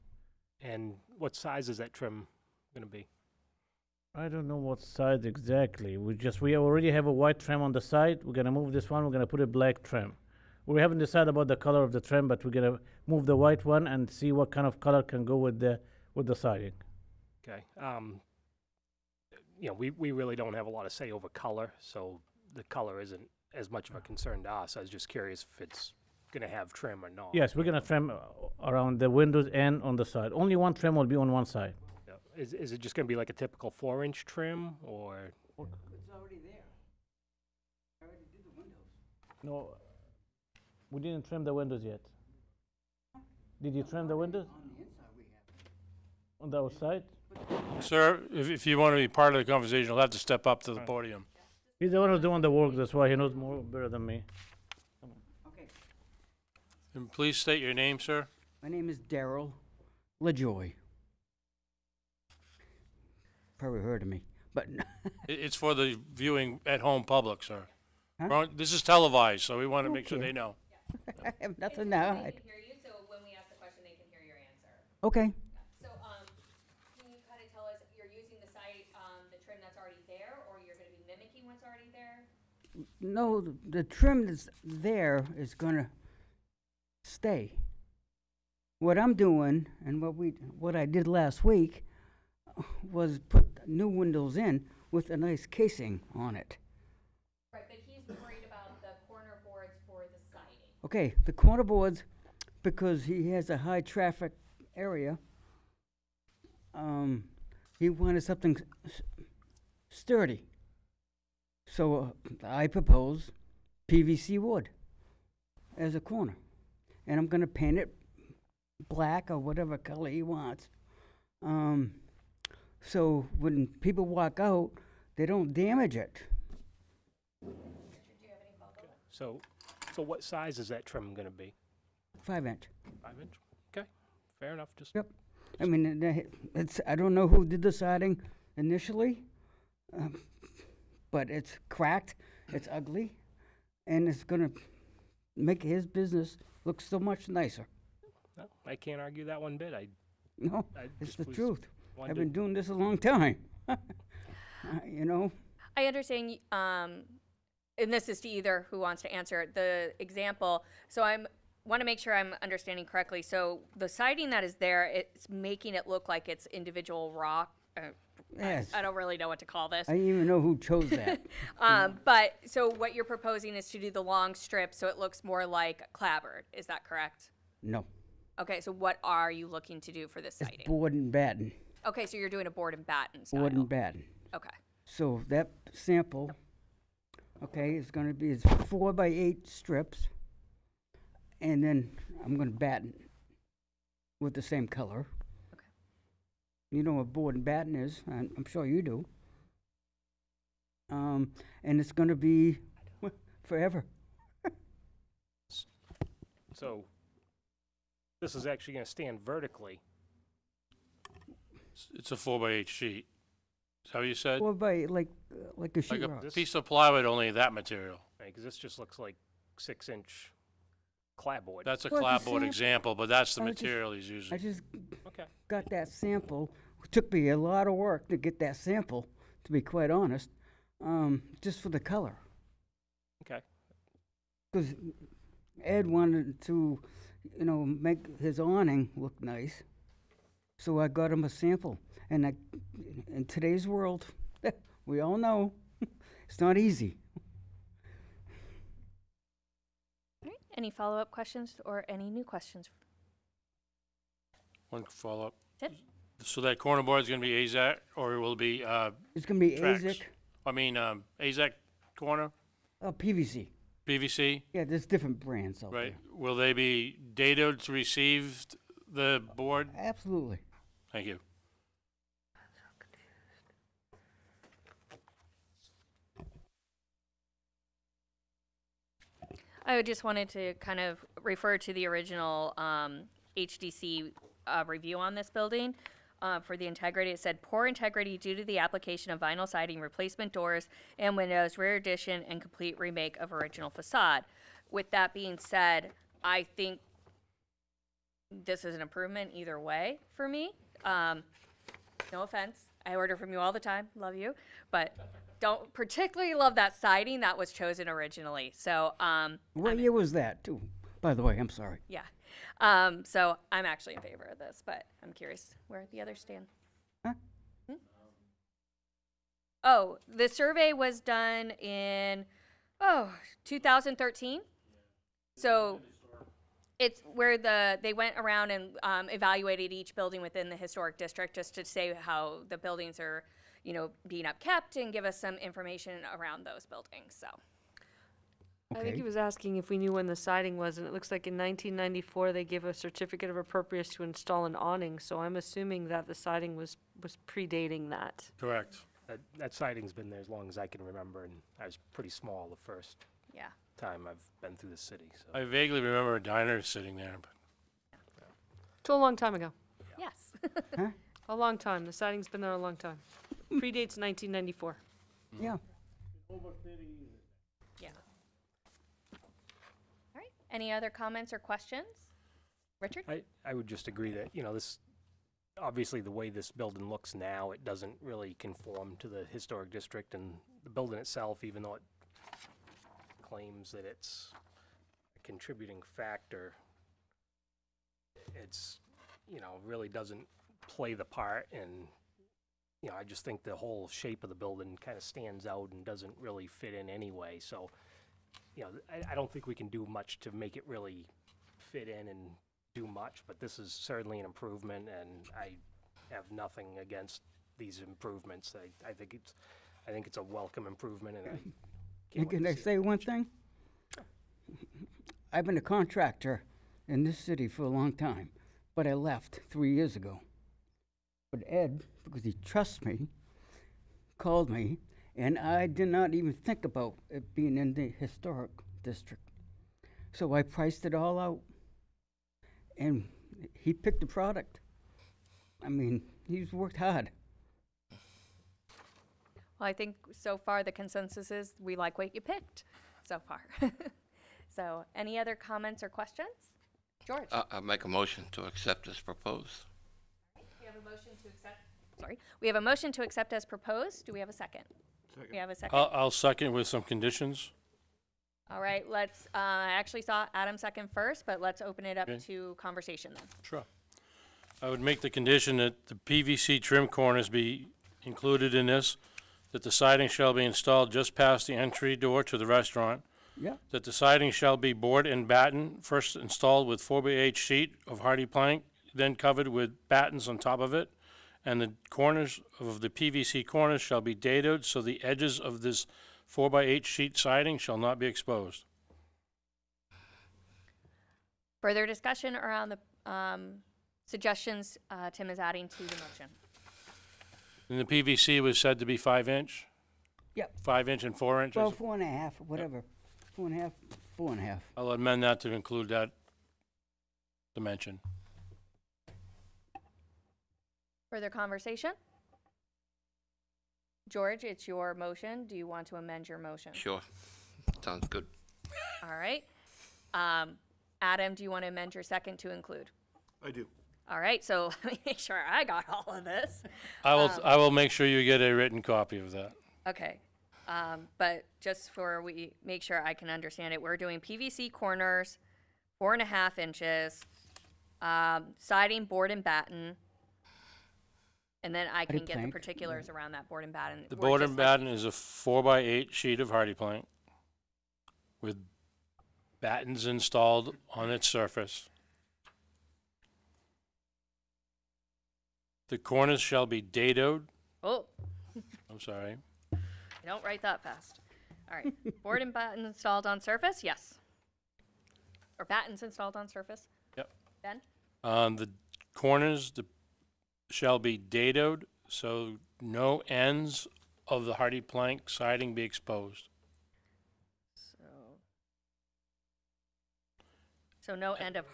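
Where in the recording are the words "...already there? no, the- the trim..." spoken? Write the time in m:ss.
1:21.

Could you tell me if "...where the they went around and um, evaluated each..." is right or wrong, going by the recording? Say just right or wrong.
right.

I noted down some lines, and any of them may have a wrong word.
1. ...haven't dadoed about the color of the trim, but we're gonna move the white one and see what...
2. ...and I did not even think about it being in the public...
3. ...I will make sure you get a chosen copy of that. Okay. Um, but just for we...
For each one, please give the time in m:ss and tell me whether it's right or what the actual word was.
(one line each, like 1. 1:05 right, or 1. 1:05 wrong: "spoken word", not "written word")
1. 0:10 wrong: "decided", not "dadoed"
2. 7:05 wrong: "historic", not "public"
3. 8:47 wrong: "written", not "chosen".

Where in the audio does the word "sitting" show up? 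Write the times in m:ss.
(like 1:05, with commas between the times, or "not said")
5:56.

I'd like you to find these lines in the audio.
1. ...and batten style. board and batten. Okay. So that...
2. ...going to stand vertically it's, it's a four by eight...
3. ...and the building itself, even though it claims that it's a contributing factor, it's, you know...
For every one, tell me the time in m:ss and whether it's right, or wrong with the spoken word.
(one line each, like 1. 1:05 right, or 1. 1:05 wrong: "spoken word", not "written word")
1. 3:02 right
2. 3:28 right
3. 6:20 right.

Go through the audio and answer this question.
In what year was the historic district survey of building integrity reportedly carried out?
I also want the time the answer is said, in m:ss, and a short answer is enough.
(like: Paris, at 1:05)
2013, at 5:23.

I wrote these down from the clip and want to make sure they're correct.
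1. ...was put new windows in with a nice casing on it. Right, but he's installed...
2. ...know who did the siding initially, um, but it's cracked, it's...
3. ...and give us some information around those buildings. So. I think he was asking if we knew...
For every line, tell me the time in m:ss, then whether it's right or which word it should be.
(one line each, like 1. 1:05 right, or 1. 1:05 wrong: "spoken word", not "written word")
1. 1:32 wrong: "worried", not "installed"
2. 2:17 right
3. 5:34 right.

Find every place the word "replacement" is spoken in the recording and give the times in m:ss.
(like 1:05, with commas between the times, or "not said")
4:49.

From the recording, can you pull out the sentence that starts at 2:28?
No, I can't argue that one bit, I, No, I it's the was- truth.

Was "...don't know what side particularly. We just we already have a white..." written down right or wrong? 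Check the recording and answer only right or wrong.
wrong.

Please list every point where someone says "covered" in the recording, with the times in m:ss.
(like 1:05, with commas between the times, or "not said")
7:59.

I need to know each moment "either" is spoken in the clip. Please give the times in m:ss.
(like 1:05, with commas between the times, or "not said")
2:38, 4:59.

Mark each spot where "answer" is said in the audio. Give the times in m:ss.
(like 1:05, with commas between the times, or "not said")
1:14, 2:39.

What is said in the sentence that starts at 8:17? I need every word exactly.
And the PVC was said to be five inch, Yep, five inch and four inches?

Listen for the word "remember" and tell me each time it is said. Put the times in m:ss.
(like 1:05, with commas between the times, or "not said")
5:50, 5:55.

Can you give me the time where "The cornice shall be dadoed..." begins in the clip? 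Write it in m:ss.
9:15.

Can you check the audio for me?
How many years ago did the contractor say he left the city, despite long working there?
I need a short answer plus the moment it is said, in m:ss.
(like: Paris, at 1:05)
3, at 6:59.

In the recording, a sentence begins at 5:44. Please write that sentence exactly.
So I'm assuming that the siding was was predating that.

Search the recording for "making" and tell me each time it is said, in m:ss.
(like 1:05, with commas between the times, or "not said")
2:45.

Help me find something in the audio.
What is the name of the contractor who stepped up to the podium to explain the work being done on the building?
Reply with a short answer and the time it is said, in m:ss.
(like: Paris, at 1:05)
Daryl LaJoy, at 0:58.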